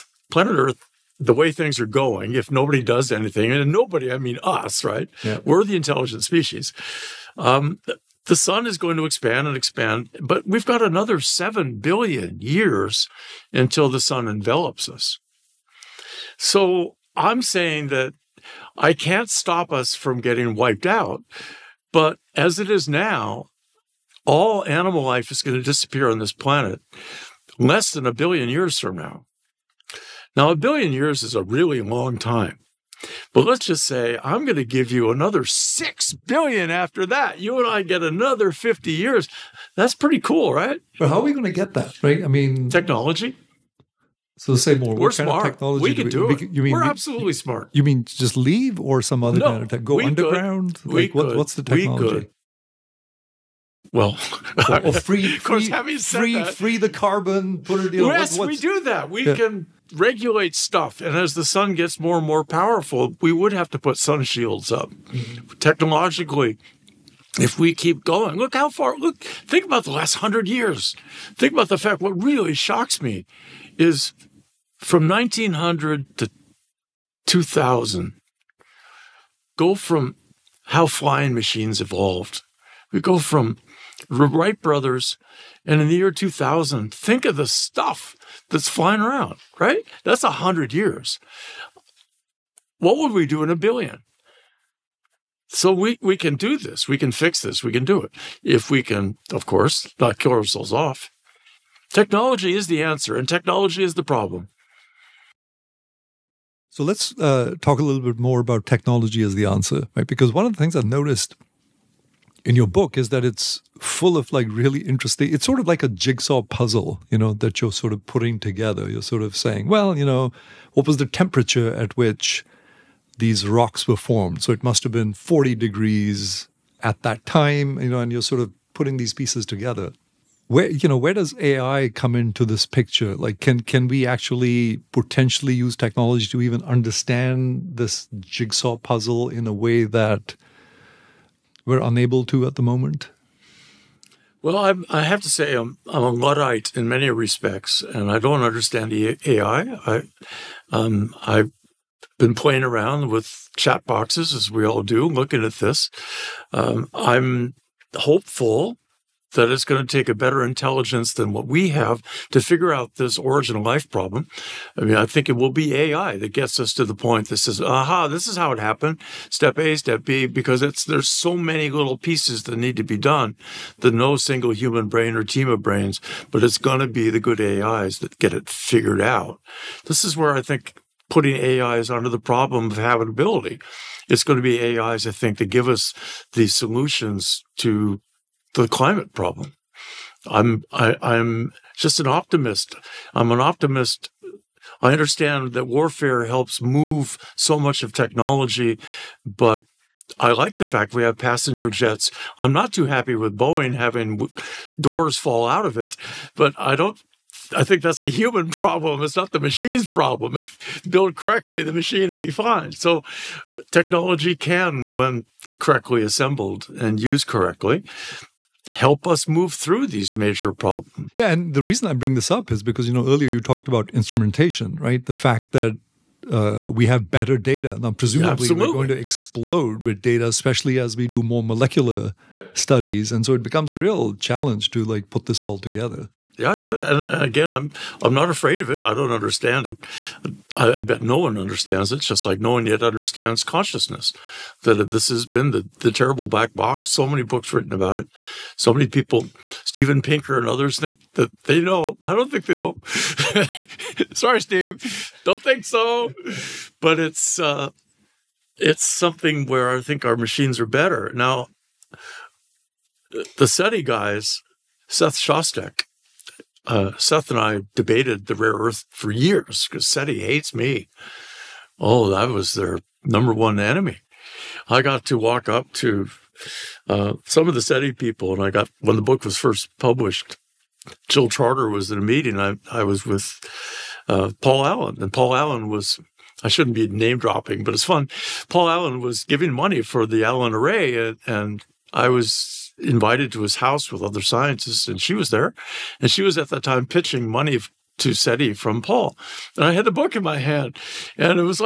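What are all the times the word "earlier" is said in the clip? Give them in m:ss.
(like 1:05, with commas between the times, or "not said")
3:43.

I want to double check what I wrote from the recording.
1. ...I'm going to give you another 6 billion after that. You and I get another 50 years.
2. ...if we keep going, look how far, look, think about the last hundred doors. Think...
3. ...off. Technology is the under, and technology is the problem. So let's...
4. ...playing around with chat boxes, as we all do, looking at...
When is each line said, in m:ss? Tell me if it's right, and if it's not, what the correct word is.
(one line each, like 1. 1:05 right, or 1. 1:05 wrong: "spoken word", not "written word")
1. 0:34 right
2. 1:07 wrong: "years", not "doors"
3. 1:40 wrong: "answer", not "under"
4. 2:32 right.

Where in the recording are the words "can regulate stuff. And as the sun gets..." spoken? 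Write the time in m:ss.
0:59.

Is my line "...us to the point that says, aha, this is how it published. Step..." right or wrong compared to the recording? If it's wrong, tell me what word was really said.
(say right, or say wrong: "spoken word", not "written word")
wrong: "happened", not "published".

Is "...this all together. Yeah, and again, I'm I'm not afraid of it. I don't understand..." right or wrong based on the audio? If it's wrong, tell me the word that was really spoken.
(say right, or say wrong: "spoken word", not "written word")
right.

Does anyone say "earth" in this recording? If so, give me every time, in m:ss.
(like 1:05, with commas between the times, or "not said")
0:00, 4:28.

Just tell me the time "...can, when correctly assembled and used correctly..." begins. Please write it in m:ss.
3:34.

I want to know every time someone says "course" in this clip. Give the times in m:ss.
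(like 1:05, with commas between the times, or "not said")
0:55, 1:39.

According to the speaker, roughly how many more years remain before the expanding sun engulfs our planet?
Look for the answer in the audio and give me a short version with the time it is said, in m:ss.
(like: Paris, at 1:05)
7 billion years, at 0:11.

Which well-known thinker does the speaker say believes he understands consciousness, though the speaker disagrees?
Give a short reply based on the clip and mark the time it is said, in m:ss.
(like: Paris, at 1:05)
Steven Pinker, at 4:09.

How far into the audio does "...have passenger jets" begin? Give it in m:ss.
3:21.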